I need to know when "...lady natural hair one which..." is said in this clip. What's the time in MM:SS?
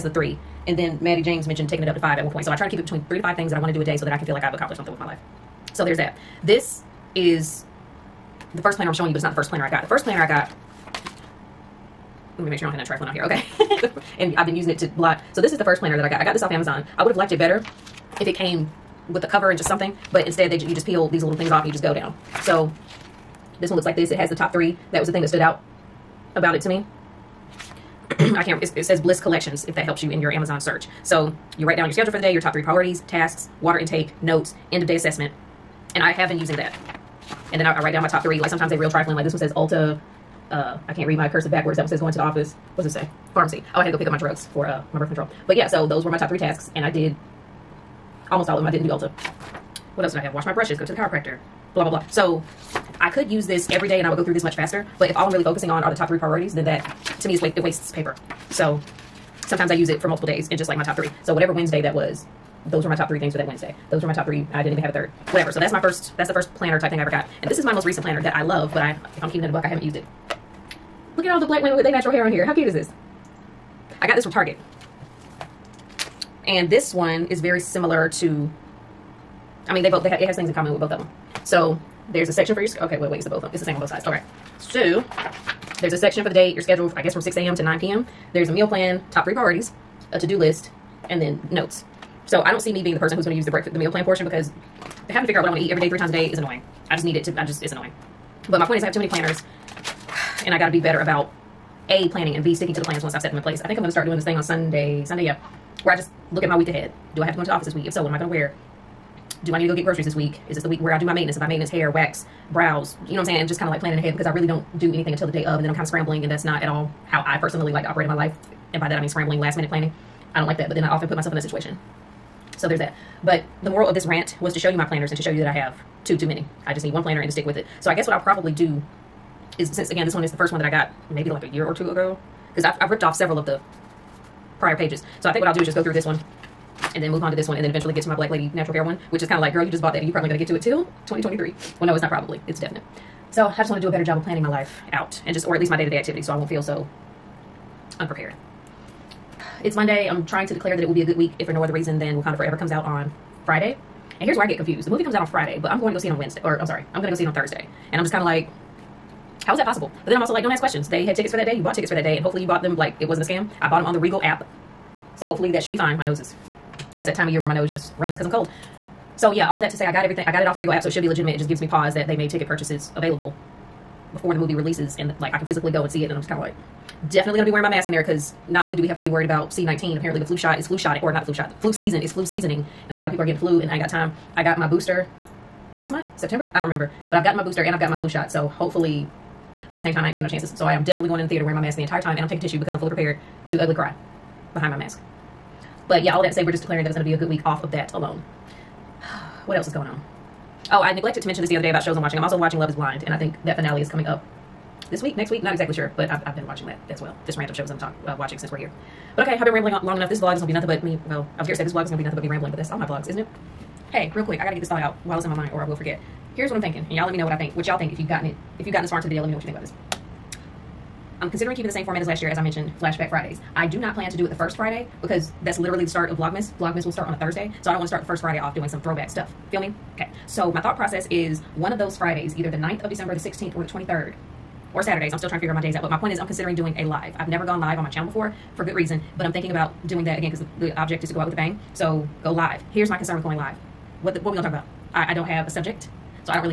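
02:18.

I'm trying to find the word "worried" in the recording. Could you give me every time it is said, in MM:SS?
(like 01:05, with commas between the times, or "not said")
02:59.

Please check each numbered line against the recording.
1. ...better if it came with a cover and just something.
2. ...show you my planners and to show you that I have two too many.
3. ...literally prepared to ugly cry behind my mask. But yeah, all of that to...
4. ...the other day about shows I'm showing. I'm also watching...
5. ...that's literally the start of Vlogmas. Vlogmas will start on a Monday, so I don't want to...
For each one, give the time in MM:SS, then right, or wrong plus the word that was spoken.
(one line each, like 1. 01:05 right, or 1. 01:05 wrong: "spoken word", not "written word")
1. 00:17 right
2. 02:04 right
3. 03:12 wrong: "fully", not "literally"
4. 03:21 wrong: "watching", not "showing"
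5. 03:45 wrong: "Thursday", not "Monday".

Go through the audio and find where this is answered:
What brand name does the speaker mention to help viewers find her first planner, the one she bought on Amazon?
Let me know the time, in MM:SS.
00:28.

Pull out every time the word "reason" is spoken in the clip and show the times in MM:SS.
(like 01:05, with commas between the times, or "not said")
02:31, 03:58.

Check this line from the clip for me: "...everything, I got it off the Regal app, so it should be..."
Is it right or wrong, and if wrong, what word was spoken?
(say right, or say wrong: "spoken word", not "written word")
right.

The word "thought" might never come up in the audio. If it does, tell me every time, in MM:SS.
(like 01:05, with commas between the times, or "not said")
03:34, 03:50.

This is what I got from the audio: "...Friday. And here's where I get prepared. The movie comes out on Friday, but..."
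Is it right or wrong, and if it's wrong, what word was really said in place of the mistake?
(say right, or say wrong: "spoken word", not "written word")
wrong: "confused", not "prepared".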